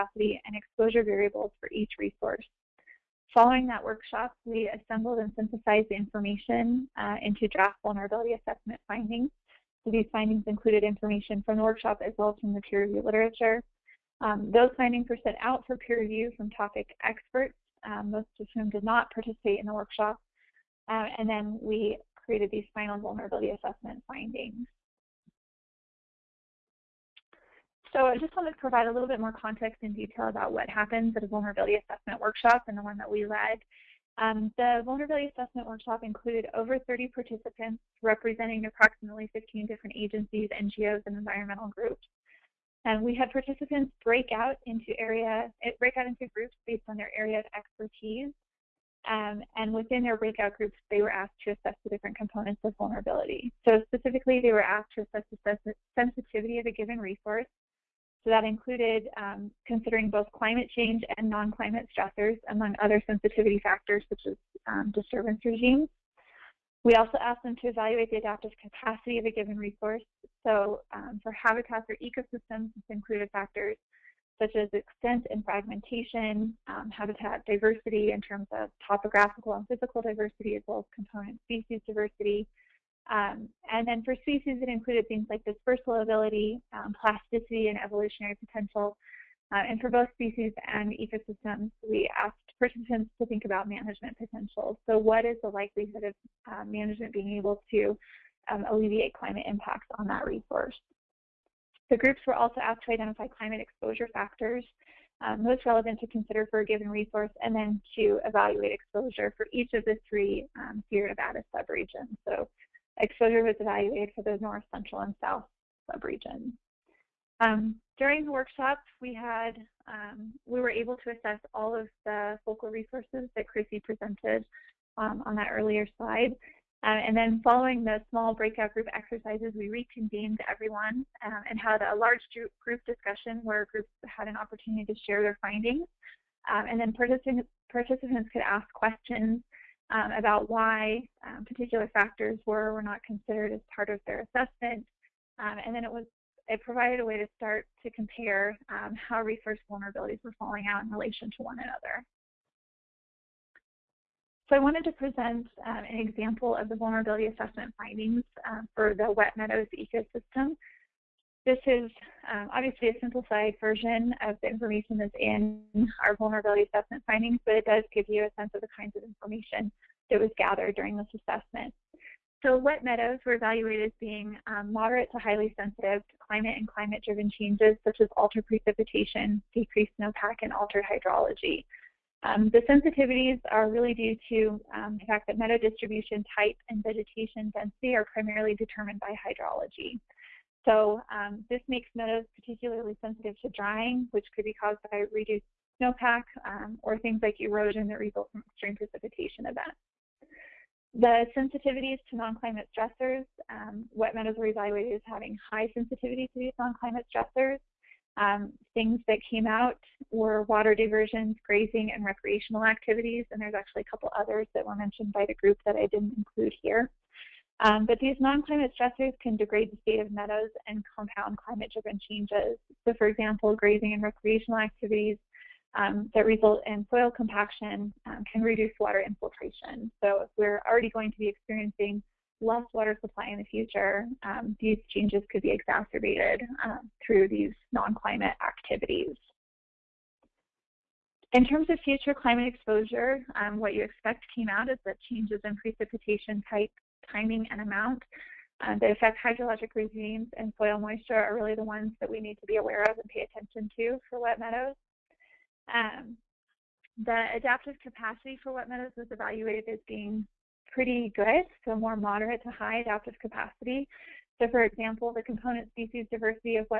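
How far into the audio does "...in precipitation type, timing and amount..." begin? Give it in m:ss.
4:05.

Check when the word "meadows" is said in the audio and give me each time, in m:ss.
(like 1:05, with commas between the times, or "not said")
2:39, 2:52, 3:05, 3:11, 3:24, 3:40, 4:14, 4:18.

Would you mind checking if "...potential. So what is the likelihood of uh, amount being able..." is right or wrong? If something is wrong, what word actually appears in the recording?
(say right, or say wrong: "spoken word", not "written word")
wrong: "management", not "amount".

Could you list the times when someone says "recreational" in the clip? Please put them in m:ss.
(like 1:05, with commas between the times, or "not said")
3:32, 3:44.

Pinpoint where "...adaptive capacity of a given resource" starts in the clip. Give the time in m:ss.
1:08.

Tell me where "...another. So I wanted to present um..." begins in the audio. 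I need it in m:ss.
2:31.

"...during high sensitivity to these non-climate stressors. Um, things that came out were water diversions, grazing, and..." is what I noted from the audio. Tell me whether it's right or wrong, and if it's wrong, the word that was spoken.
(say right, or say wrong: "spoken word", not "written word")
wrong: "having", not "during".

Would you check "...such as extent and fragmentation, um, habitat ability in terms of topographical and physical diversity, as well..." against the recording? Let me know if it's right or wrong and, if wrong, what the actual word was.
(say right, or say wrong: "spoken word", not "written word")
wrong: "diversity", not "ability".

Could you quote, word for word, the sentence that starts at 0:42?
And we had participants break out into area, eh, break out into groups based on their area of expertise.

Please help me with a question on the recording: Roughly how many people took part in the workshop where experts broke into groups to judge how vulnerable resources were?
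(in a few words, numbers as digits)
over 30.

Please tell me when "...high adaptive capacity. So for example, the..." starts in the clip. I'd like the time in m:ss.
4:22.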